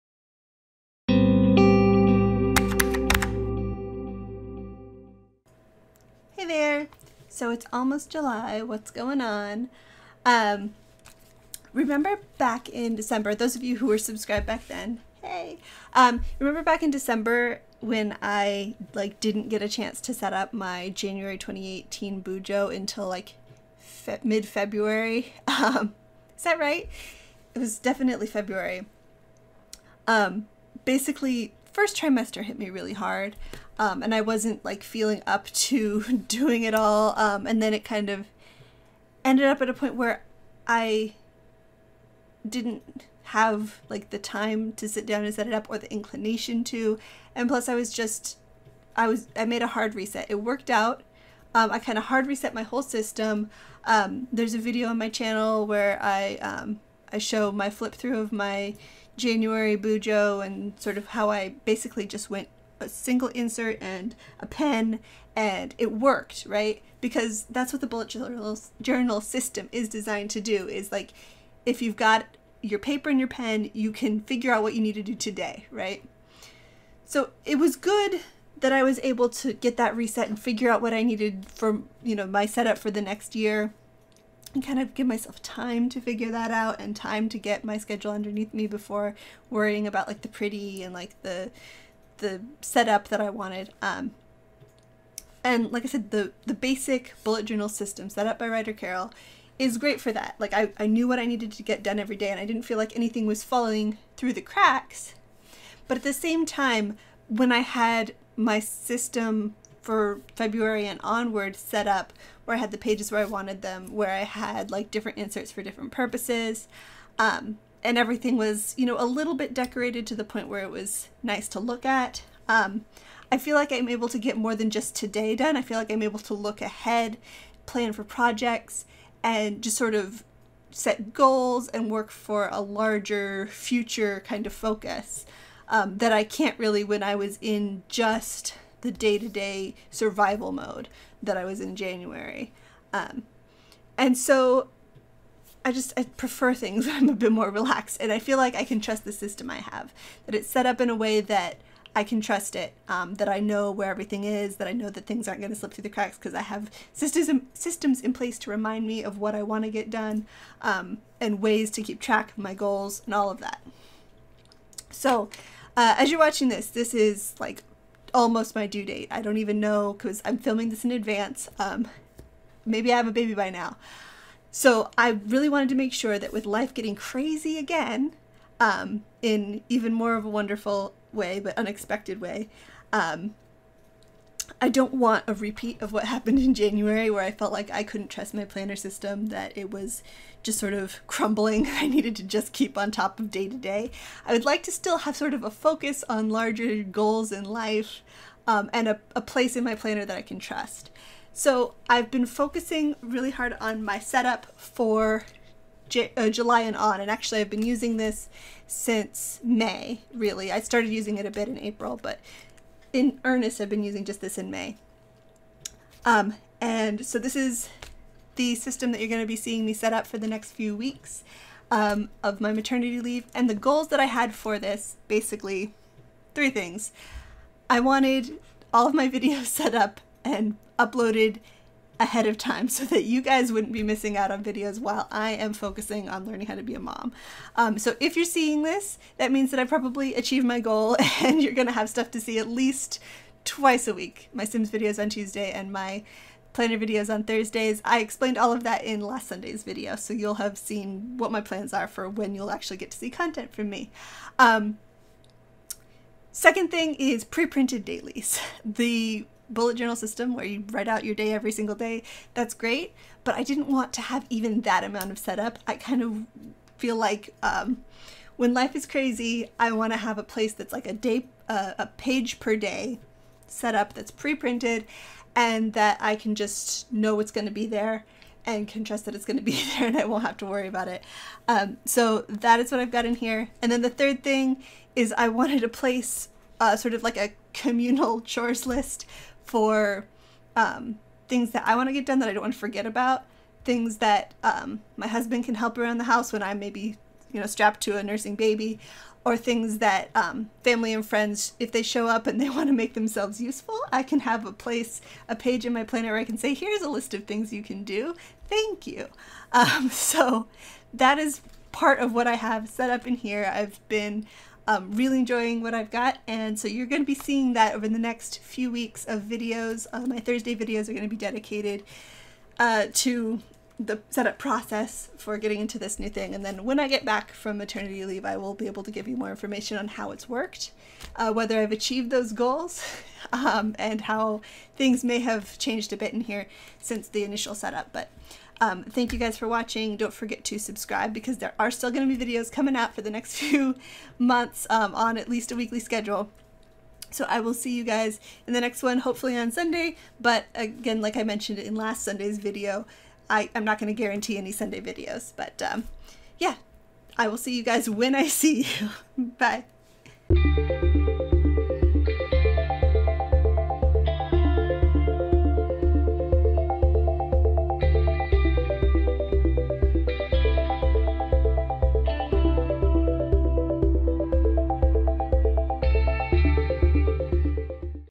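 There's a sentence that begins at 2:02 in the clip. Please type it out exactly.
Um, I feel like I'm able to get more than just today done.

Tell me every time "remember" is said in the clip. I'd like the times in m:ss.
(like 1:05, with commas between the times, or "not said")
0:11, 0:16.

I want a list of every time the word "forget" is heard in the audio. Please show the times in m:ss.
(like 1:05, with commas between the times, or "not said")
4:52, 5:40.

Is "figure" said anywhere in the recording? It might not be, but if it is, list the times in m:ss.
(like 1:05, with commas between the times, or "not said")
1:14, 1:20, 1:26.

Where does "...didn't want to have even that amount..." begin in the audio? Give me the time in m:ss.
4:23.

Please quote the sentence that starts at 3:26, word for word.
And actually, I've been using this since May, really.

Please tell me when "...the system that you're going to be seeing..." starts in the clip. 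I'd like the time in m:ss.
3:38.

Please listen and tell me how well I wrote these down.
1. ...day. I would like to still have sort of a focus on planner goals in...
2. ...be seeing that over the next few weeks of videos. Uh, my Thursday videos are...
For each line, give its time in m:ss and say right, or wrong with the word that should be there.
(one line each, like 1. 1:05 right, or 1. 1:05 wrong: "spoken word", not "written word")
1. 3:13 wrong: "larger", not "planner"
2. 5:17 right.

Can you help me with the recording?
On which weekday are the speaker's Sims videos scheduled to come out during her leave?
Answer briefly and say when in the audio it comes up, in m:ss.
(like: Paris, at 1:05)
Tuesday, at 4:05.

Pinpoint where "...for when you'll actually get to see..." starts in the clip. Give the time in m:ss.
4:11.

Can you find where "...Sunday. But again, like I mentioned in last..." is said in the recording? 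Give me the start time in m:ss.
5:49.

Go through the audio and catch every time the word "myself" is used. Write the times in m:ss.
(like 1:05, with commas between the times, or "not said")
1:25.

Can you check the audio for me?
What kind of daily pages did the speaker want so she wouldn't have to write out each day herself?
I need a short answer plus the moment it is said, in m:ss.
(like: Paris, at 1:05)
pre-printed dailies, at 4:17.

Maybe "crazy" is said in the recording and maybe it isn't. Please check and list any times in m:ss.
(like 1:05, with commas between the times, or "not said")
2:56, 4:28.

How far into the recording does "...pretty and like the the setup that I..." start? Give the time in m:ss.
1:30.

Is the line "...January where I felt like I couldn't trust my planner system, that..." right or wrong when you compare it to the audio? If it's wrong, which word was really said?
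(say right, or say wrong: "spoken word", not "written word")
right.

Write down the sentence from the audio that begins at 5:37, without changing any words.
But um, thank you guys for watching.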